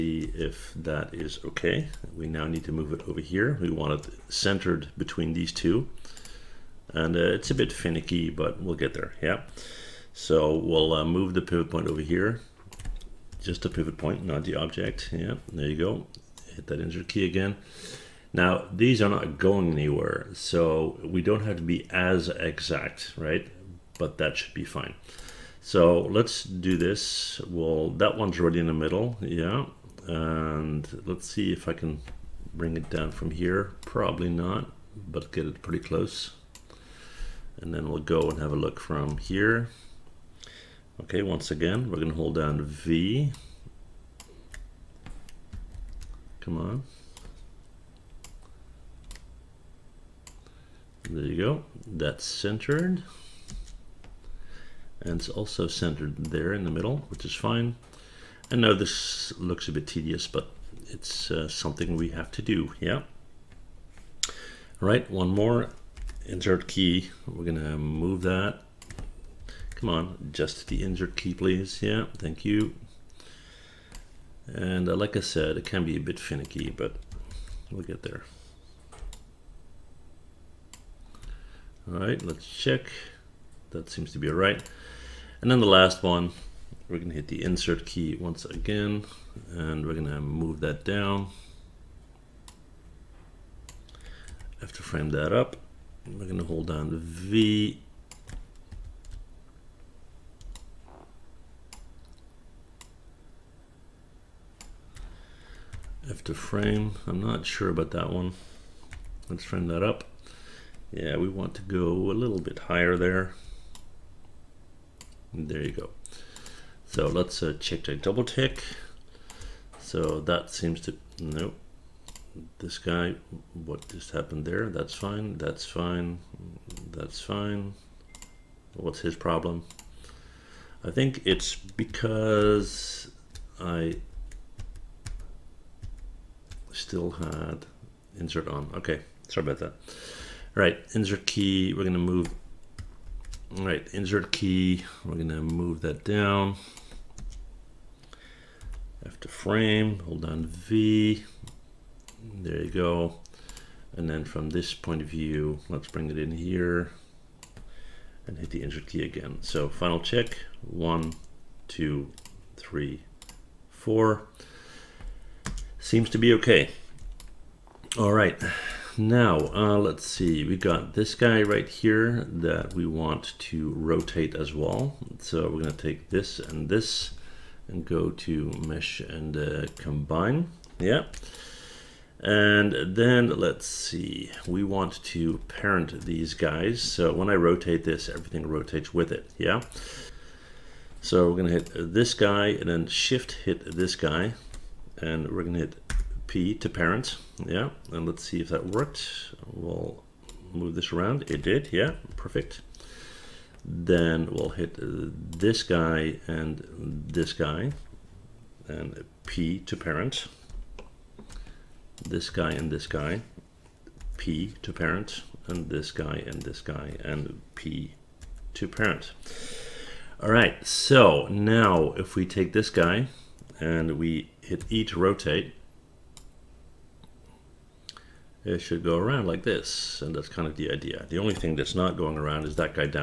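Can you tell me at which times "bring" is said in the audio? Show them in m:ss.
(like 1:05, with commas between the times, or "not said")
0:32, 2:35.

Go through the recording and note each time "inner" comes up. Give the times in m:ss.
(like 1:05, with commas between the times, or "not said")
not said.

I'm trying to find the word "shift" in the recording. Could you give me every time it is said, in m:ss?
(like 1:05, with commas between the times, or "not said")
3:12.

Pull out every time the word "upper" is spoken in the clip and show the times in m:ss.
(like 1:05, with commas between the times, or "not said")
not said.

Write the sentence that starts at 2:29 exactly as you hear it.
After frame, hold down V, there you go.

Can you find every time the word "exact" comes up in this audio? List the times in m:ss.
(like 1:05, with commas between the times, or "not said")
0:22.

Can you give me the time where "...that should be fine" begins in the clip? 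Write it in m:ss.
0:24.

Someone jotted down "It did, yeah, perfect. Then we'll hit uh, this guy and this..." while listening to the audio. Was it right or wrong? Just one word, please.
right.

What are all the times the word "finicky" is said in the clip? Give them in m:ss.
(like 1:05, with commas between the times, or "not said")
0:07, 1:16.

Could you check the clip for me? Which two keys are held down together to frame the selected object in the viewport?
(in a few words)
V F.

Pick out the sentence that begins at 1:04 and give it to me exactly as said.
All right, one more insert key.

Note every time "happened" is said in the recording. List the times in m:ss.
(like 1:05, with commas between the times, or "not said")
2:04.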